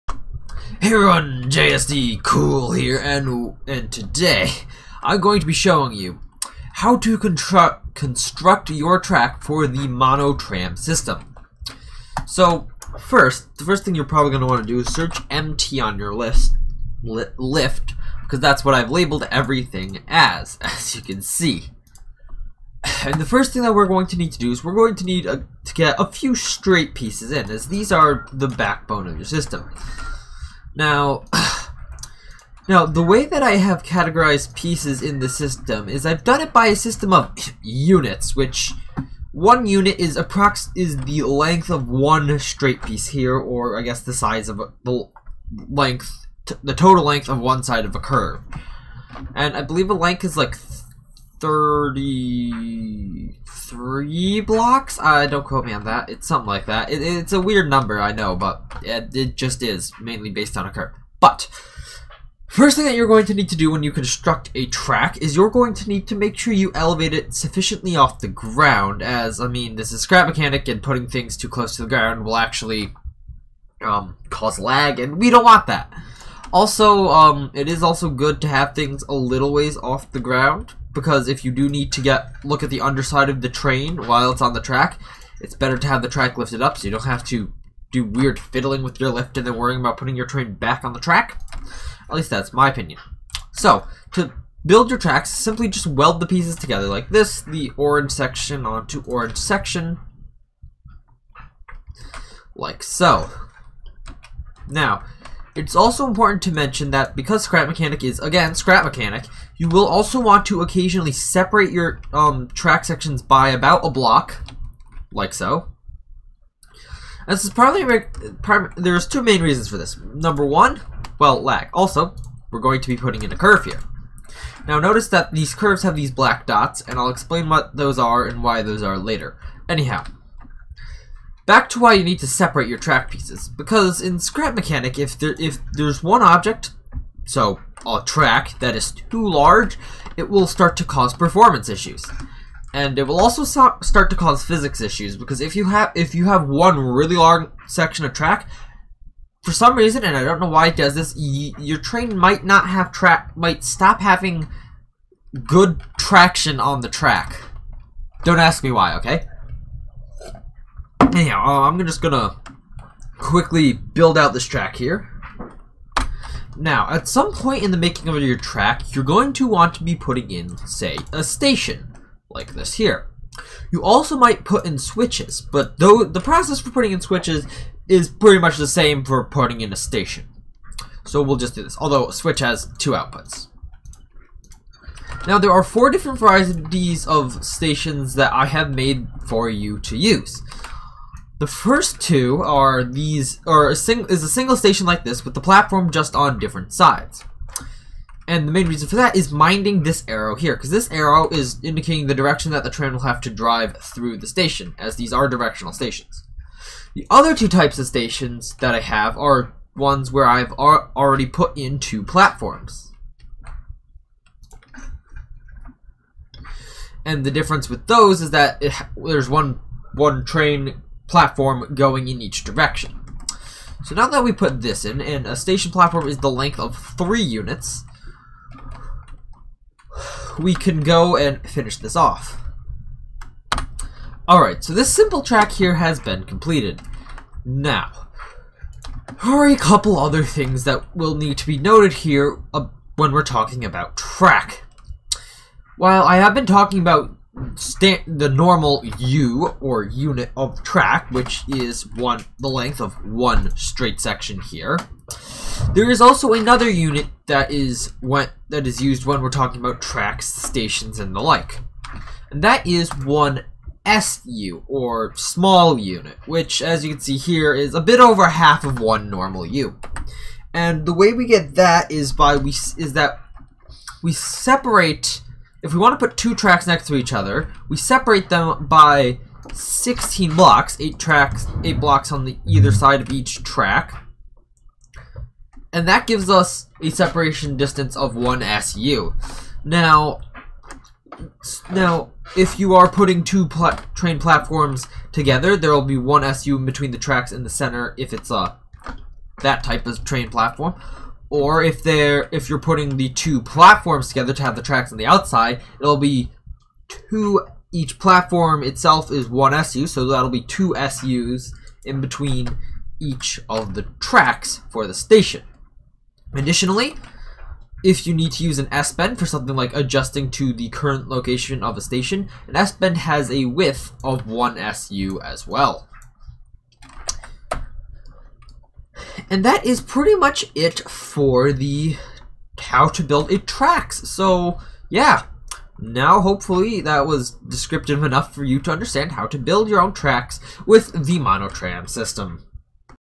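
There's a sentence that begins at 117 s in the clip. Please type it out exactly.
And this is probably, there's two main reasons for this.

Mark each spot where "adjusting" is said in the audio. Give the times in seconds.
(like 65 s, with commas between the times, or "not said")
319 s.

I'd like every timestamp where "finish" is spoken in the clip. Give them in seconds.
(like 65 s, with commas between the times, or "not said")
231 s.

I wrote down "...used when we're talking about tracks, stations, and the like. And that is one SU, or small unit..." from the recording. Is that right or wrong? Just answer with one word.
right.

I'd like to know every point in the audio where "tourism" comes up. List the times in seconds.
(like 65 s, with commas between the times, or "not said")
not said.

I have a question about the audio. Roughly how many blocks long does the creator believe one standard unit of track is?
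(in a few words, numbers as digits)
33.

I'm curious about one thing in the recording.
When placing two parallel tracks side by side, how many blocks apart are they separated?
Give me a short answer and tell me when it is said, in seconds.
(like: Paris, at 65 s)
16, at 279 s.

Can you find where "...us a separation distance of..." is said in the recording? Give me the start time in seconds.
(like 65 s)
286 s.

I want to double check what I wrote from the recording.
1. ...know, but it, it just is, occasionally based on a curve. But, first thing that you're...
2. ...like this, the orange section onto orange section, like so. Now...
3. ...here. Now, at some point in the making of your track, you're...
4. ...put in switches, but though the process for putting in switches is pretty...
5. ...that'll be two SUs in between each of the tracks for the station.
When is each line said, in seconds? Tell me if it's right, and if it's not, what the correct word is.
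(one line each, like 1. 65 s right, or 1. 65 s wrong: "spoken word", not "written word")
1. 58 s wrong: "mainly", not "occasionally"
2. 96 s right
3. 164 s right
4. 174 s right
5. 310 s right.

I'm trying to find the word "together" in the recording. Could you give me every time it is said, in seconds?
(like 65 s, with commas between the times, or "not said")
96 s, 295 s, 304 s.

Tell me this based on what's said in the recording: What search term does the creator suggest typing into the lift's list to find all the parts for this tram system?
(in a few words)
MT.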